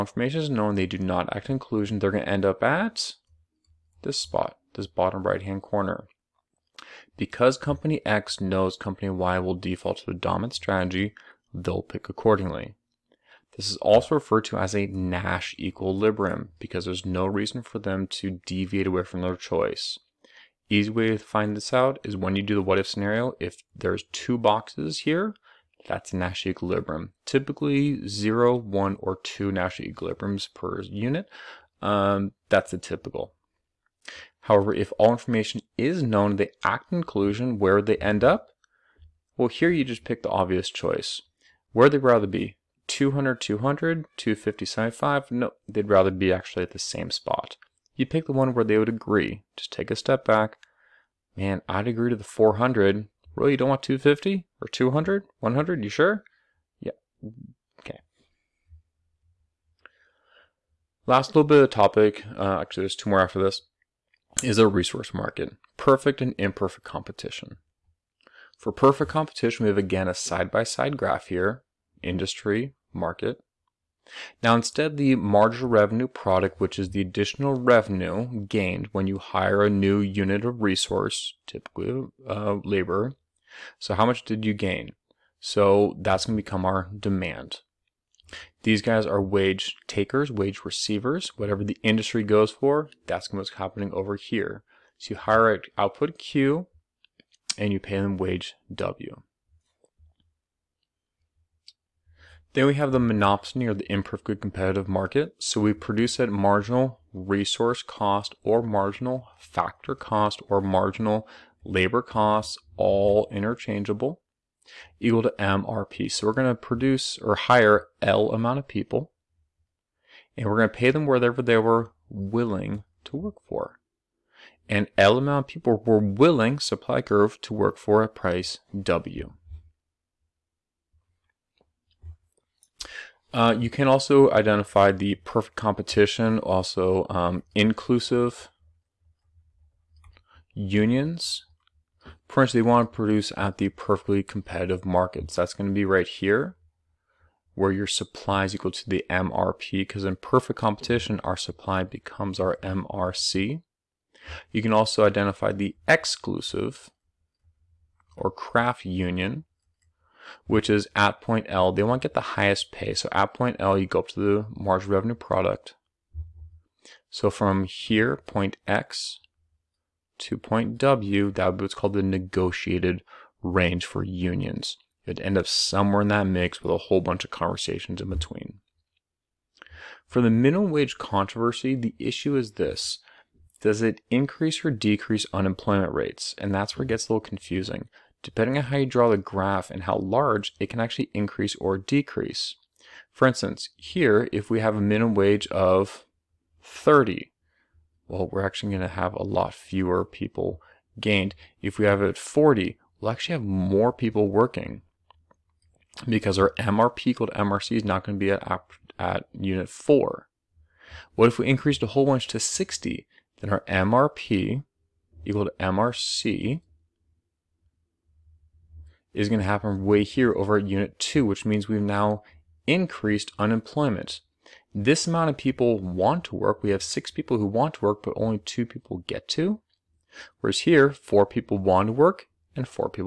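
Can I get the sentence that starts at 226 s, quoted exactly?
We have six people who want to work, but only two people get to.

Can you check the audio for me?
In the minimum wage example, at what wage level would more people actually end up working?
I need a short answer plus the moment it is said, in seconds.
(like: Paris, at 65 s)
40, at 202 s.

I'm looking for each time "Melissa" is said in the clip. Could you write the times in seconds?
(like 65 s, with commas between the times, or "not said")
not said.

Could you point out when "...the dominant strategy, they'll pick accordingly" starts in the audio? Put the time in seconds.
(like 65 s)
10 s.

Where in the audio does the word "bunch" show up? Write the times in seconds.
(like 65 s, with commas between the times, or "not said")
176 s, 212 s.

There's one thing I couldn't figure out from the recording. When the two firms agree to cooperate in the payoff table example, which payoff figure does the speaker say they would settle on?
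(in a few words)
400.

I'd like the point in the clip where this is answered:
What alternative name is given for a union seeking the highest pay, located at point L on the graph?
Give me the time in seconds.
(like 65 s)
158 s.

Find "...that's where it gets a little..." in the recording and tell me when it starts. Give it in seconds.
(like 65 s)
186 s.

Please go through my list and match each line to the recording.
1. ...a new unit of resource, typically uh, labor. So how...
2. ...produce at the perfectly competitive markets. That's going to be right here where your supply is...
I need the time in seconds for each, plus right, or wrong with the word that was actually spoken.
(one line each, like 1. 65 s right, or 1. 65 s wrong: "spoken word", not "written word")
1. 79 s right
2. 142 s right.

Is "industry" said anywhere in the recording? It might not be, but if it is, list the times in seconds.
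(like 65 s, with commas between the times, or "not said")
72 s, 91 s.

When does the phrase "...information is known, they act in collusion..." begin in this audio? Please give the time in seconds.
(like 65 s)
35 s.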